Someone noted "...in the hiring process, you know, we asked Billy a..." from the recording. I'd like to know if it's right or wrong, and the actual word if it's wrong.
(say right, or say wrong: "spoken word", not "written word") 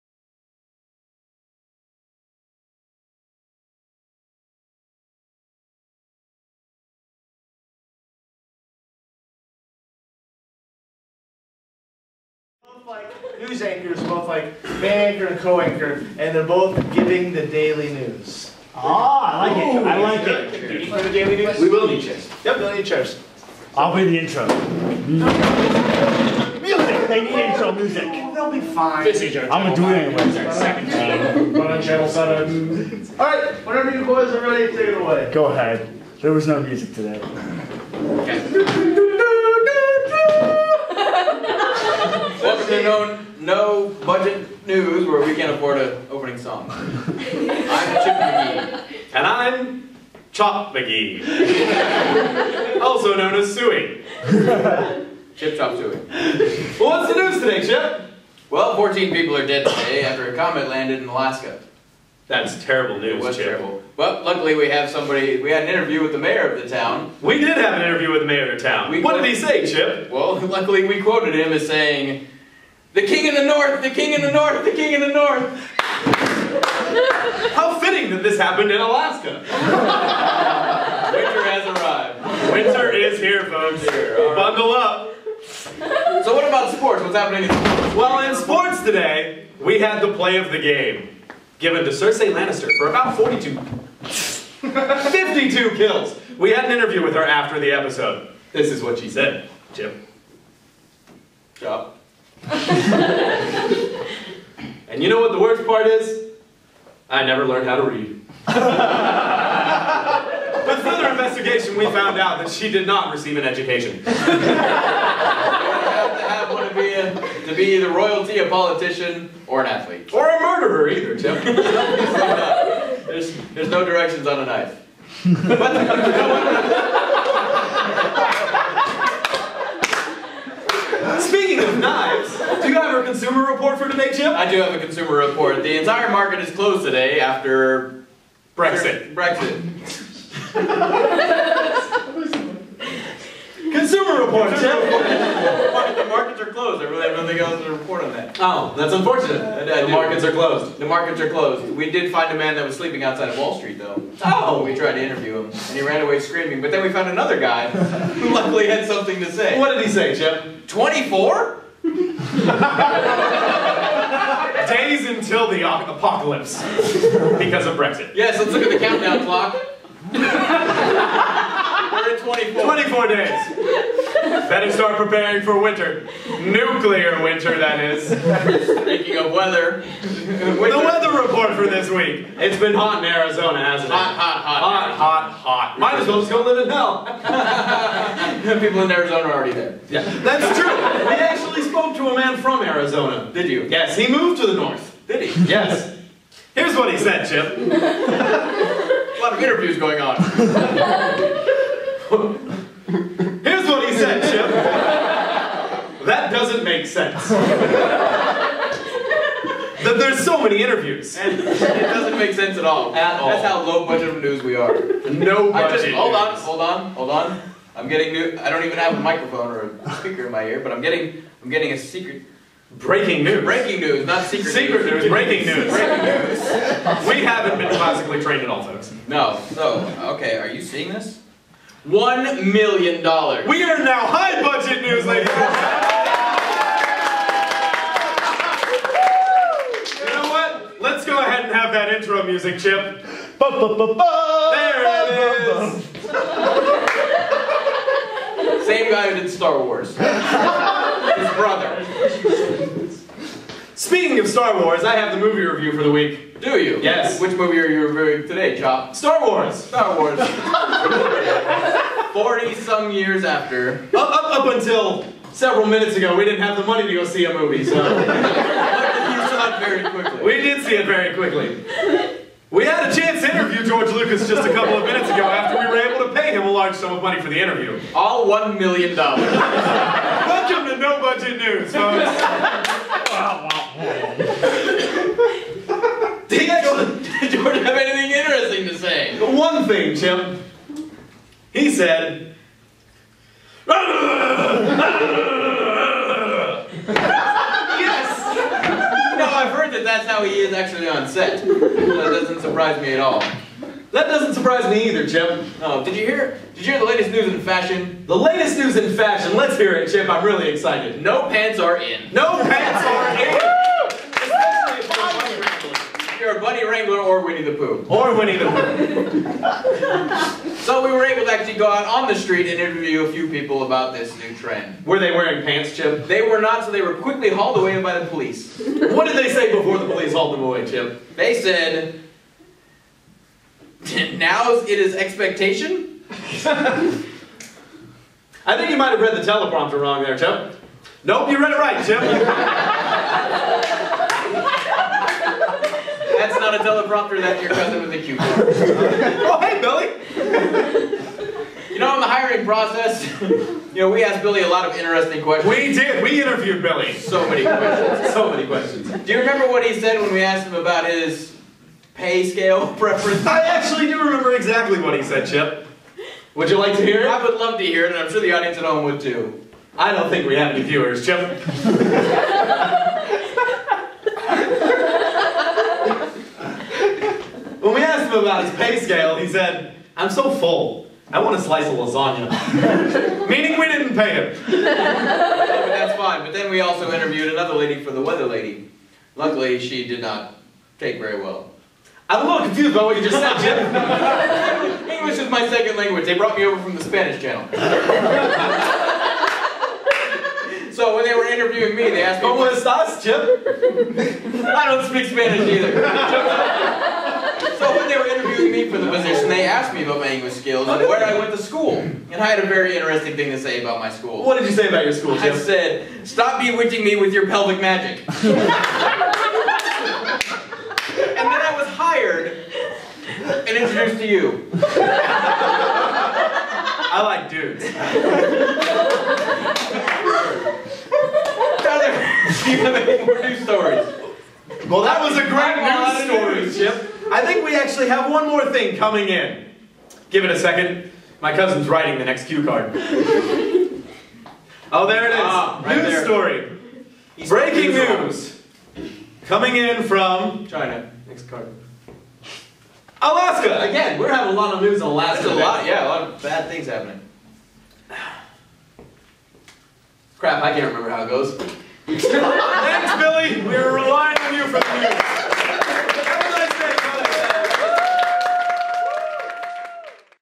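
right.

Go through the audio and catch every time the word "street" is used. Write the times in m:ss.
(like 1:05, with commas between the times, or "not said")
2:33, 5:22.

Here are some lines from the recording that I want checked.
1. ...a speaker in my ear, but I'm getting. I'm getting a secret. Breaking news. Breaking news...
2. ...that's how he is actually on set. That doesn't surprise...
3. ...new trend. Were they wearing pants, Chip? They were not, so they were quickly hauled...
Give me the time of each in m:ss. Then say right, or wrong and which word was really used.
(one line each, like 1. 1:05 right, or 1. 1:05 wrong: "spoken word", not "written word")
1. 3:39 right
2. 4:59 right
3. 5:24 right.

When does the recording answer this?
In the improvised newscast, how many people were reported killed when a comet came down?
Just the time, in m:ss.
0:58.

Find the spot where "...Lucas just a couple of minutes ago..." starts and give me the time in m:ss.
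4:33.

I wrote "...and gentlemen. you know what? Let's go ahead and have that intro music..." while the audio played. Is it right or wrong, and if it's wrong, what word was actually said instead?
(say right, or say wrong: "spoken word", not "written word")
right.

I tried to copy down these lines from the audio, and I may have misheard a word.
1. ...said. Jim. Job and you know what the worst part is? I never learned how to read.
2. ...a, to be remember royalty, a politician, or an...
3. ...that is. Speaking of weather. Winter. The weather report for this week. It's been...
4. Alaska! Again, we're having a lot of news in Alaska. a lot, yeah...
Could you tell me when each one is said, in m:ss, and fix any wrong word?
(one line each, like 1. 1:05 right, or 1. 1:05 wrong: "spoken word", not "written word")
1. 1:39 right
2. 1:56 wrong: "either", not "remember"
3. 2:57 right
4. 7:33 right.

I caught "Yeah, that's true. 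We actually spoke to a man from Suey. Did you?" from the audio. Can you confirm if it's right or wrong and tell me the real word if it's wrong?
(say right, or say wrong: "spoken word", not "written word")
wrong: "Arizona", not "Suey".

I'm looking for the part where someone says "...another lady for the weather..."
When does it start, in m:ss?
6:27.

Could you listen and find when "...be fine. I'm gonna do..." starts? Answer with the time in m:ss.
0:28.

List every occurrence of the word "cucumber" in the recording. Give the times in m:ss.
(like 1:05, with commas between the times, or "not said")
5:47.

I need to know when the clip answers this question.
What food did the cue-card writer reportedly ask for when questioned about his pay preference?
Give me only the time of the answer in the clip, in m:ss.
6:21.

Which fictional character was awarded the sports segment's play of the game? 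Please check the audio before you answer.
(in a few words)
Cersei Lannister.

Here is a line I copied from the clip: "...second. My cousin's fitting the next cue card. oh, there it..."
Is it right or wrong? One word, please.
wrong.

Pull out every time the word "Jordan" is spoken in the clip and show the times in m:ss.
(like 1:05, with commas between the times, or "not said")
4:47.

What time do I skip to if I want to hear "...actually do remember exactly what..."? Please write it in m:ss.
6:03.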